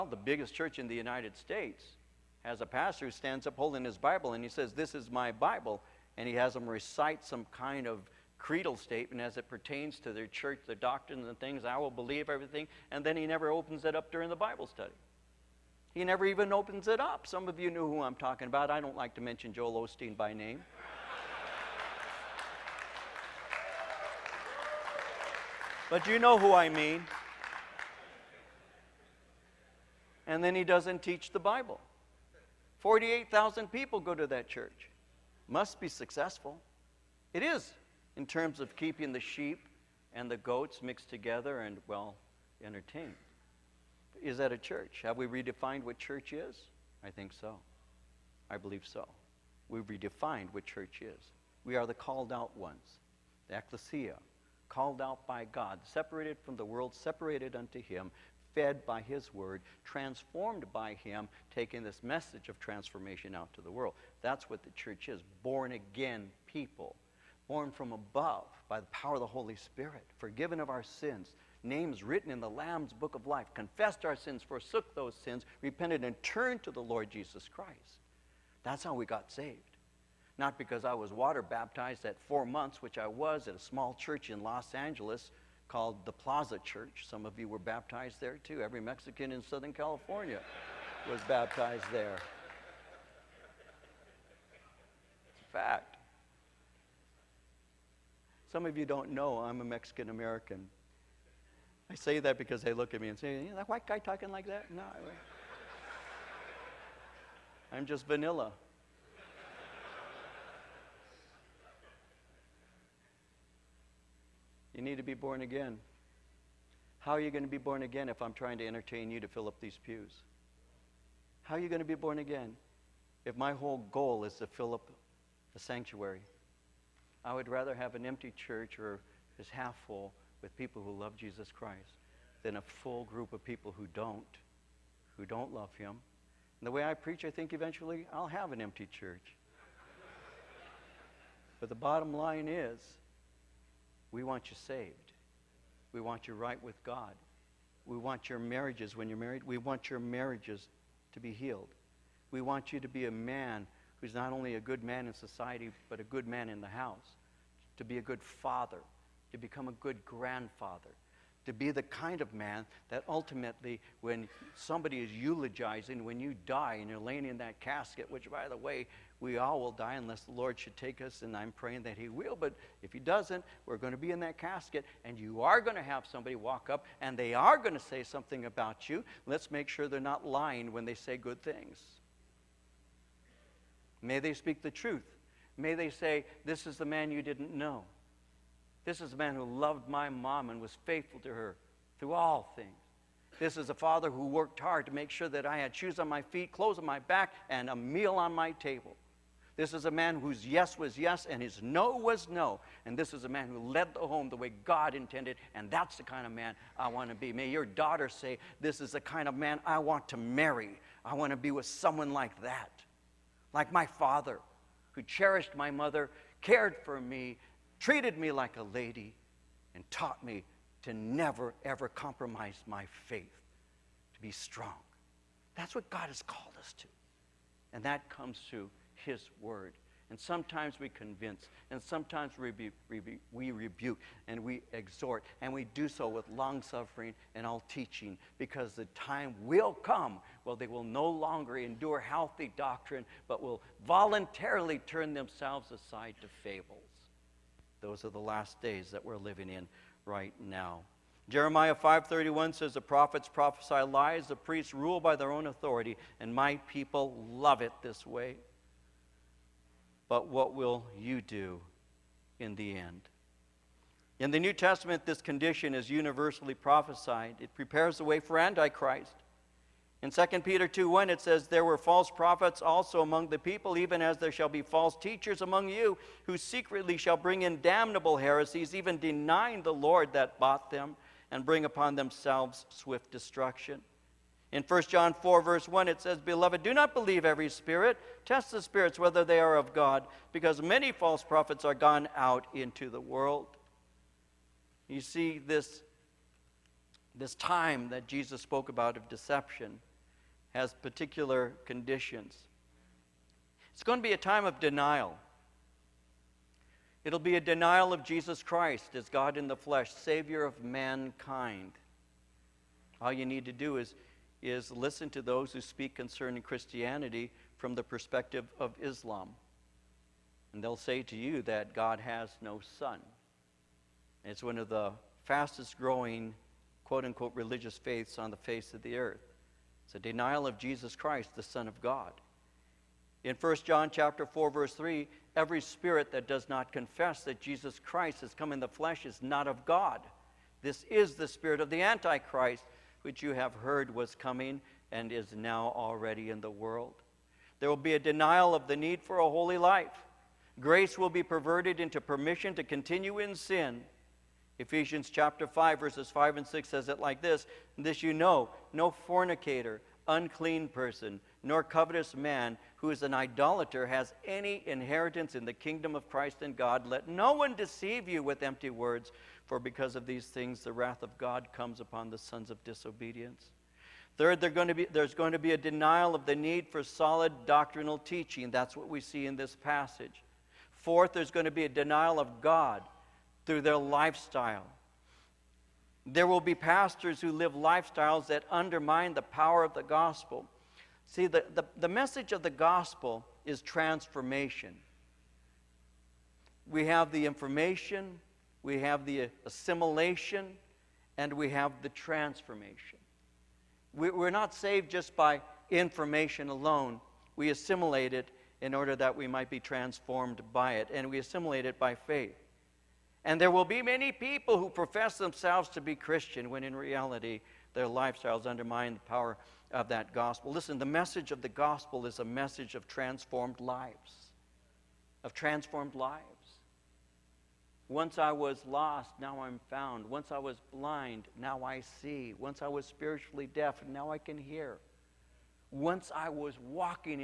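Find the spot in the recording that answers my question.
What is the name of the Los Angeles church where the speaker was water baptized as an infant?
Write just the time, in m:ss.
1:26.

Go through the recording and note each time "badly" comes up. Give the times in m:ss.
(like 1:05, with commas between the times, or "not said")
not said.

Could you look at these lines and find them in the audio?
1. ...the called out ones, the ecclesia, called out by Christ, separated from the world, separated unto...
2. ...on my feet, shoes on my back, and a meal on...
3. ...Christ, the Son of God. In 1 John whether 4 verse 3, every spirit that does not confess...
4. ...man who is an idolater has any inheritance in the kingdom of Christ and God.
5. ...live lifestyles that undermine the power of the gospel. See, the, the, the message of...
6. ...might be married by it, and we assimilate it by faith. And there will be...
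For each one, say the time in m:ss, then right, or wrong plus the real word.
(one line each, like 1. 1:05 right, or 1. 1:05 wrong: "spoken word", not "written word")
1. 0:51 wrong: "God", not "Christ"
2. 3:15 wrong: "clothes", not "shoes"
3. 5:30 wrong: "chapter", not "whether"
4. 6:02 right
5. 6:27 right
6. 6:49 wrong: "transformed", not "married".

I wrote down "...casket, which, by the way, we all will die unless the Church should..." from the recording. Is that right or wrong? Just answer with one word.
wrong.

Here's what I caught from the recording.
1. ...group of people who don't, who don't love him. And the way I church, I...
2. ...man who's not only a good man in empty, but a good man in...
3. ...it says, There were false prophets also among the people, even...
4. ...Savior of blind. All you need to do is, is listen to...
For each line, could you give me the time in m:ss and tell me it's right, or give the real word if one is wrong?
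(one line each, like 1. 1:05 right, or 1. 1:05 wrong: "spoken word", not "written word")
1. 2:13 wrong: "preach", not "church"
2. 2:33 wrong: "society", not "empty"
3. 4:31 right
4. 5:09 wrong: "mankind", not "blind".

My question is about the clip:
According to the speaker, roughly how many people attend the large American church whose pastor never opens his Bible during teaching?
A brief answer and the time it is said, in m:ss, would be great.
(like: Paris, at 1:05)
48,000, at 0:32.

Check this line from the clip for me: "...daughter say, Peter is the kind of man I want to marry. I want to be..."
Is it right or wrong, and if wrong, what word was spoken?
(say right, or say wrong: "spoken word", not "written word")
wrong: "This", not "Peter".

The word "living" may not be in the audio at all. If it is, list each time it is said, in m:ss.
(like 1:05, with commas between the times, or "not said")
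4:09.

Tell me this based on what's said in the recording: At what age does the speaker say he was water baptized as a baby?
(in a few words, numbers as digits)
4 months.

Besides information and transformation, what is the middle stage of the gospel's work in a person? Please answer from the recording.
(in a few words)
assimilation.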